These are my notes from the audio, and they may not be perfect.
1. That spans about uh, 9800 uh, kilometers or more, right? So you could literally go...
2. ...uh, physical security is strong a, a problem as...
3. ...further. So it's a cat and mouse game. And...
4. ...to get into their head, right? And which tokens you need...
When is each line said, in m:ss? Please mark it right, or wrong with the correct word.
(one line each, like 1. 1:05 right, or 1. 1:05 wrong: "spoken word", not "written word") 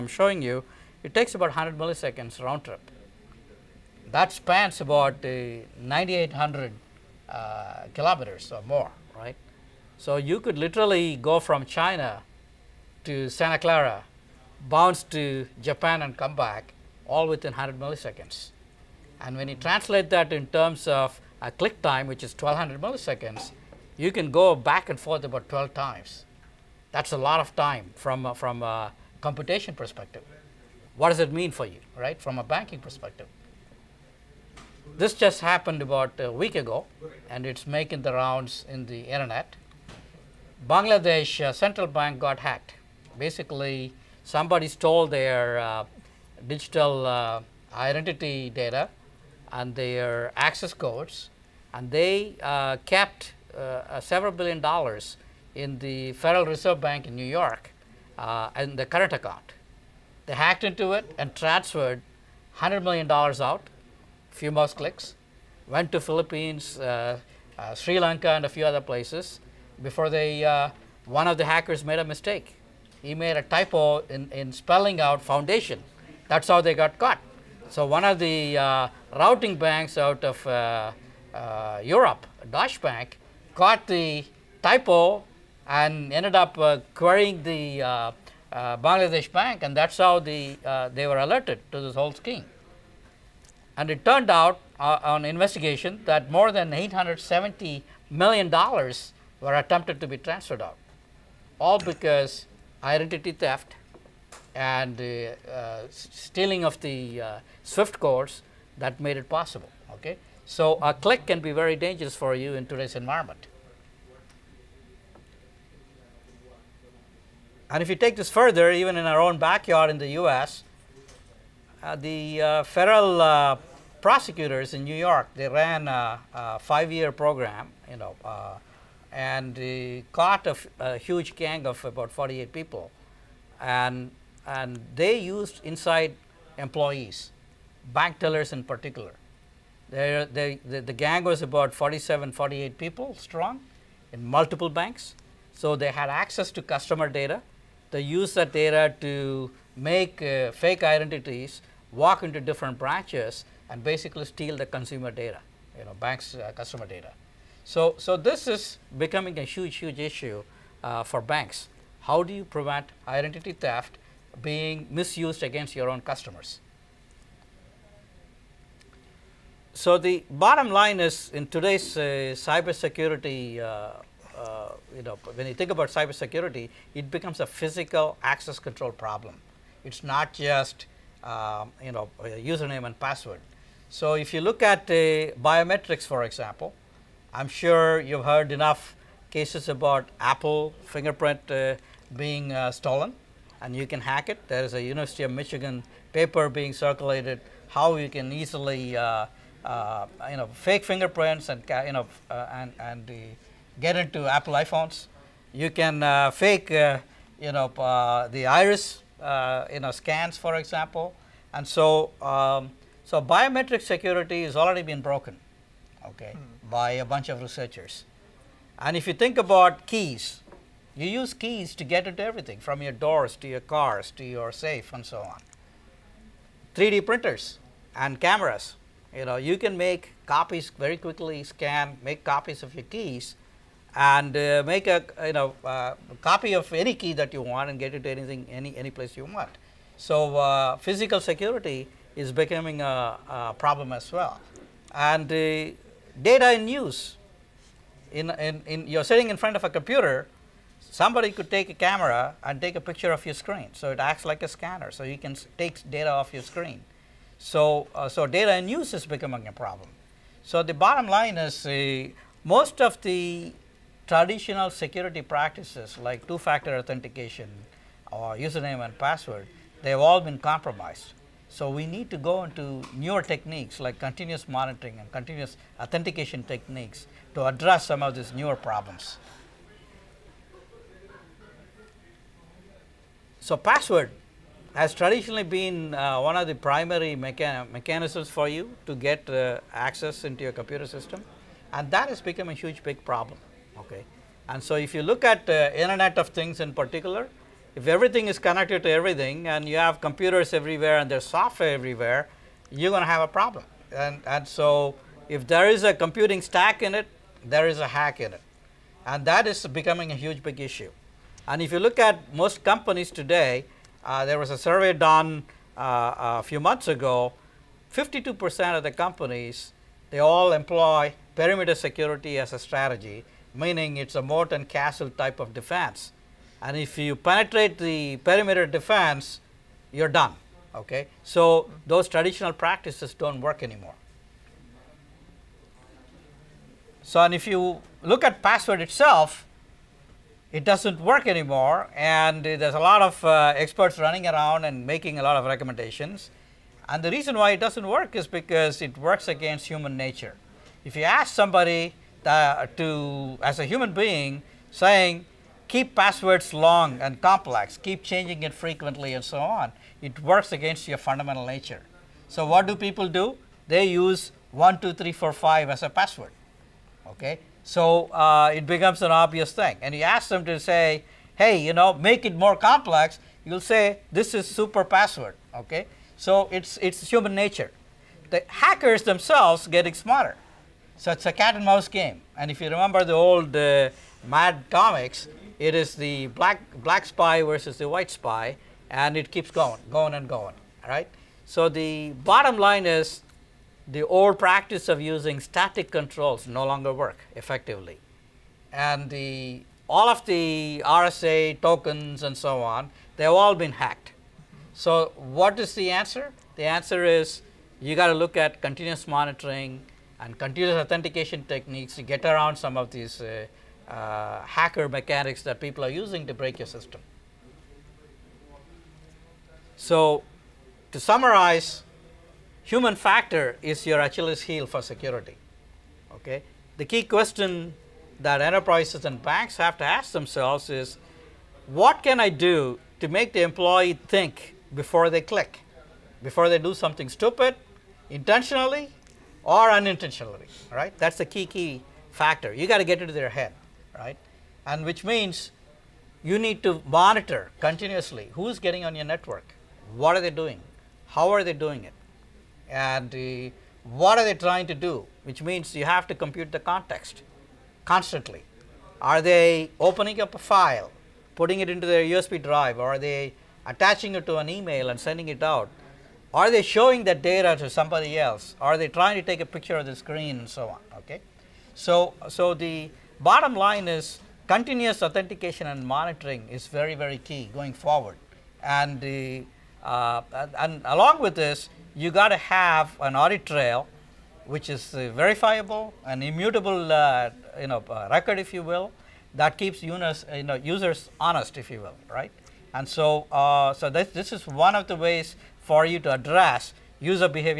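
1. 0:04 right
2. 4:00 wrong: "becoming", not "strong"
3. 6:19 wrong: "smarter", not "further"
4. 7:22 wrong: "means", not "tokens".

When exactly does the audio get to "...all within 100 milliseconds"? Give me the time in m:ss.
0:17.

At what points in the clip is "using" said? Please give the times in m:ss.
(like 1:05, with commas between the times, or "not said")
6:35, 6:55.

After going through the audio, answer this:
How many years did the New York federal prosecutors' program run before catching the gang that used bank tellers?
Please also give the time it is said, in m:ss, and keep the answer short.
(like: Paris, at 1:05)
5 years, at 2:06.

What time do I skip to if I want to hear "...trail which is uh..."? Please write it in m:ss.
8:03.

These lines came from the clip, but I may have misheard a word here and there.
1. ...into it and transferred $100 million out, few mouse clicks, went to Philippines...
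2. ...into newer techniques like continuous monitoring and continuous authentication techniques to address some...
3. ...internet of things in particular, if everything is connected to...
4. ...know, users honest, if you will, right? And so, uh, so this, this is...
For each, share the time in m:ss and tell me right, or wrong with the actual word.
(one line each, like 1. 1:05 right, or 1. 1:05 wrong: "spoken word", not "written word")
1. 1:00 right
2. 4:32 right
3. 4:55 right
4. 8:10 right.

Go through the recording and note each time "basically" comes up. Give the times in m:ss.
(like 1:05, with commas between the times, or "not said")
0:43, 2:33.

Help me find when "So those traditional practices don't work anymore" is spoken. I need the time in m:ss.
5:31.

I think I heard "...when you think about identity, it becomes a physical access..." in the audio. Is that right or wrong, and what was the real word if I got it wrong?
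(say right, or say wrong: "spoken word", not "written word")
wrong: "cybersecurity", not "identity".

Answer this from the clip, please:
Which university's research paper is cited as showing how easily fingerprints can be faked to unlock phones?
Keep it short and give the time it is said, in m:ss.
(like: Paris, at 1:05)
University of Michigan, at 3:14.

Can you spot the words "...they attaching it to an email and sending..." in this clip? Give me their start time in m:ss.
7:42.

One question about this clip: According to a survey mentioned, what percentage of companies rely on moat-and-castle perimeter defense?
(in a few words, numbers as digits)
52%.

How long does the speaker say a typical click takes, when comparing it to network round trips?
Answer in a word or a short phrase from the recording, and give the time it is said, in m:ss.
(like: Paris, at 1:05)
1200 milliseconds, at 0:22.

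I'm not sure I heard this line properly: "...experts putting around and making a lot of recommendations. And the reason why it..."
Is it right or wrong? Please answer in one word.
wrong.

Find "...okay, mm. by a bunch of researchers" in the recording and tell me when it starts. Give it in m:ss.
3:36.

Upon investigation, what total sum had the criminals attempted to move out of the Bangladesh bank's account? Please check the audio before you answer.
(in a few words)
$870 million.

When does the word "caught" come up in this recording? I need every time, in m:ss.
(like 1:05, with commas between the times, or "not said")
1:16, 1:23, 2:10.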